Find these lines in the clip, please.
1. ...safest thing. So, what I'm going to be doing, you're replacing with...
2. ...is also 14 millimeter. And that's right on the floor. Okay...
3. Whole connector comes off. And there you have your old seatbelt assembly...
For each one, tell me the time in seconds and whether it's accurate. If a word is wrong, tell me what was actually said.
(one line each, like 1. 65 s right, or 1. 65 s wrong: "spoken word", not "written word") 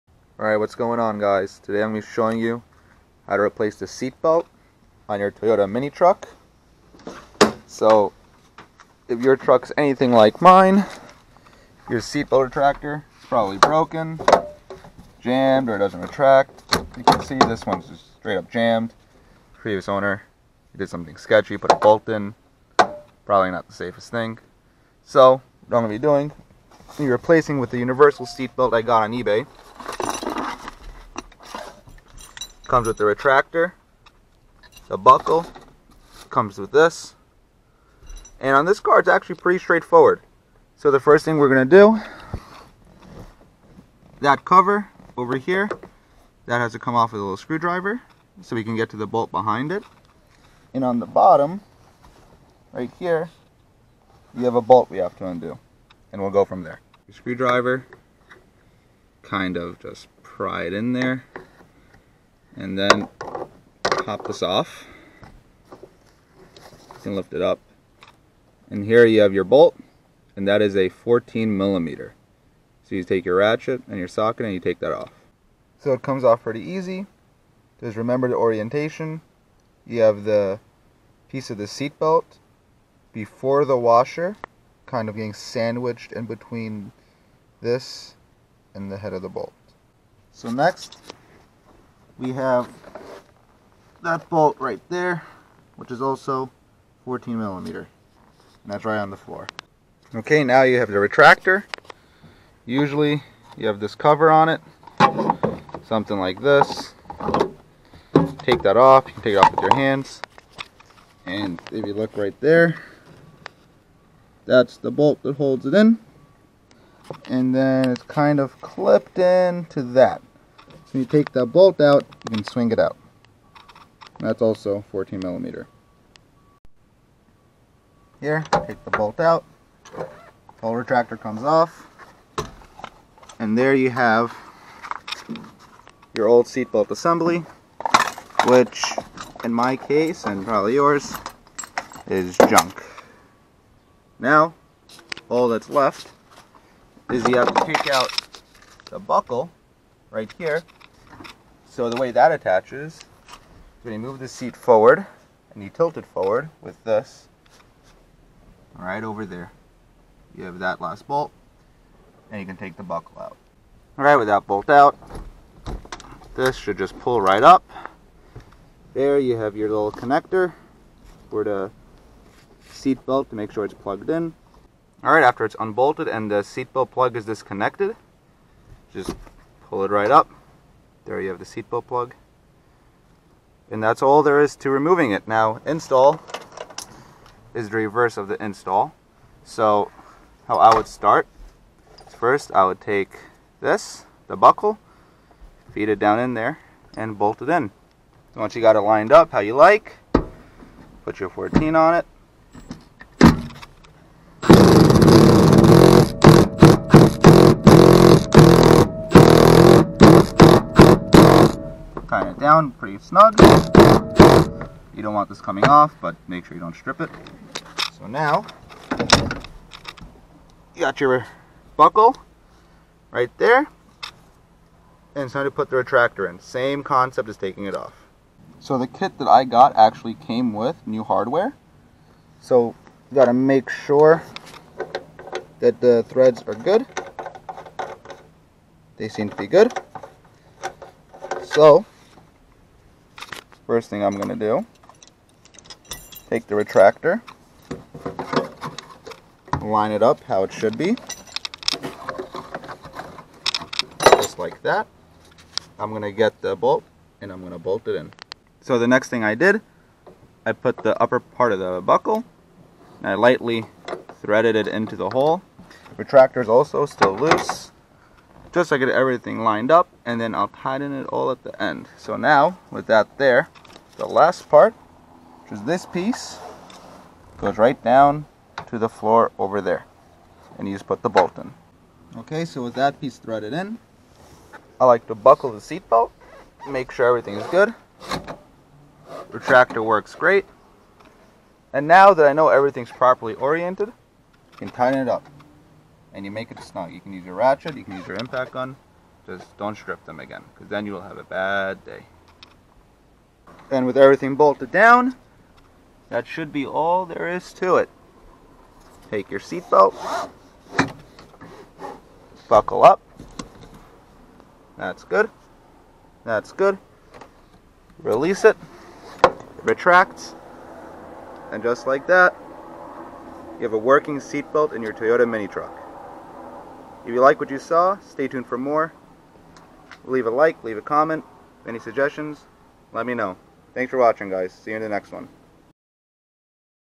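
1. 23 s right
2. 95 s right
3. 130 s wrong: "retractor", not "connector".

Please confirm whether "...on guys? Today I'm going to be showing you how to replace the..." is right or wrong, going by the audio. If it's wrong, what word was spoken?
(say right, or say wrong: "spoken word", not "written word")
right.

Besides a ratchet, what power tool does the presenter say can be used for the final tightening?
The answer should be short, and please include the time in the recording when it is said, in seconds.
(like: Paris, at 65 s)
impact gun, at 298 s.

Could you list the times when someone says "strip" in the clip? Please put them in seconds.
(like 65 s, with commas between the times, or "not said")
216 s, 299 s.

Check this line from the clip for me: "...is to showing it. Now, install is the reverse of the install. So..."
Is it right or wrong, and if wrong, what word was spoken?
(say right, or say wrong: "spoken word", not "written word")
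wrong: "removing", not "showing".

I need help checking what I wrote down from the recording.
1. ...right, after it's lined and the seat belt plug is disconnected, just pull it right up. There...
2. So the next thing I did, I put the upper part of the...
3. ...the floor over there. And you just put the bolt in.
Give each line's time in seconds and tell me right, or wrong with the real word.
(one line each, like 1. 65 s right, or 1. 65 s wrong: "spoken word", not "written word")
1. 175 s wrong: "unbolted", not "lined"
2. 258 s right
3. 278 s right.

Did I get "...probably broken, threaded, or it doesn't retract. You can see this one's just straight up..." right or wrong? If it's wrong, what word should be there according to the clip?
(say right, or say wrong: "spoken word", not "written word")
wrong: "jammed", not "threaded".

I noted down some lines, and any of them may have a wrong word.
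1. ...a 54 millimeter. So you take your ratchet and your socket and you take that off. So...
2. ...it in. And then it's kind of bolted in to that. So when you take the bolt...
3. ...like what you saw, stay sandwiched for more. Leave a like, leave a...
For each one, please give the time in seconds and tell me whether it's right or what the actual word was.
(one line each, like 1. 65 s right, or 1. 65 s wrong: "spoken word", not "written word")
1. 70 s wrong: "14", not "54"
2. 115 s wrong: "clipped", not "bolted"
3. 327 s wrong: "tuned", not "sandwiched".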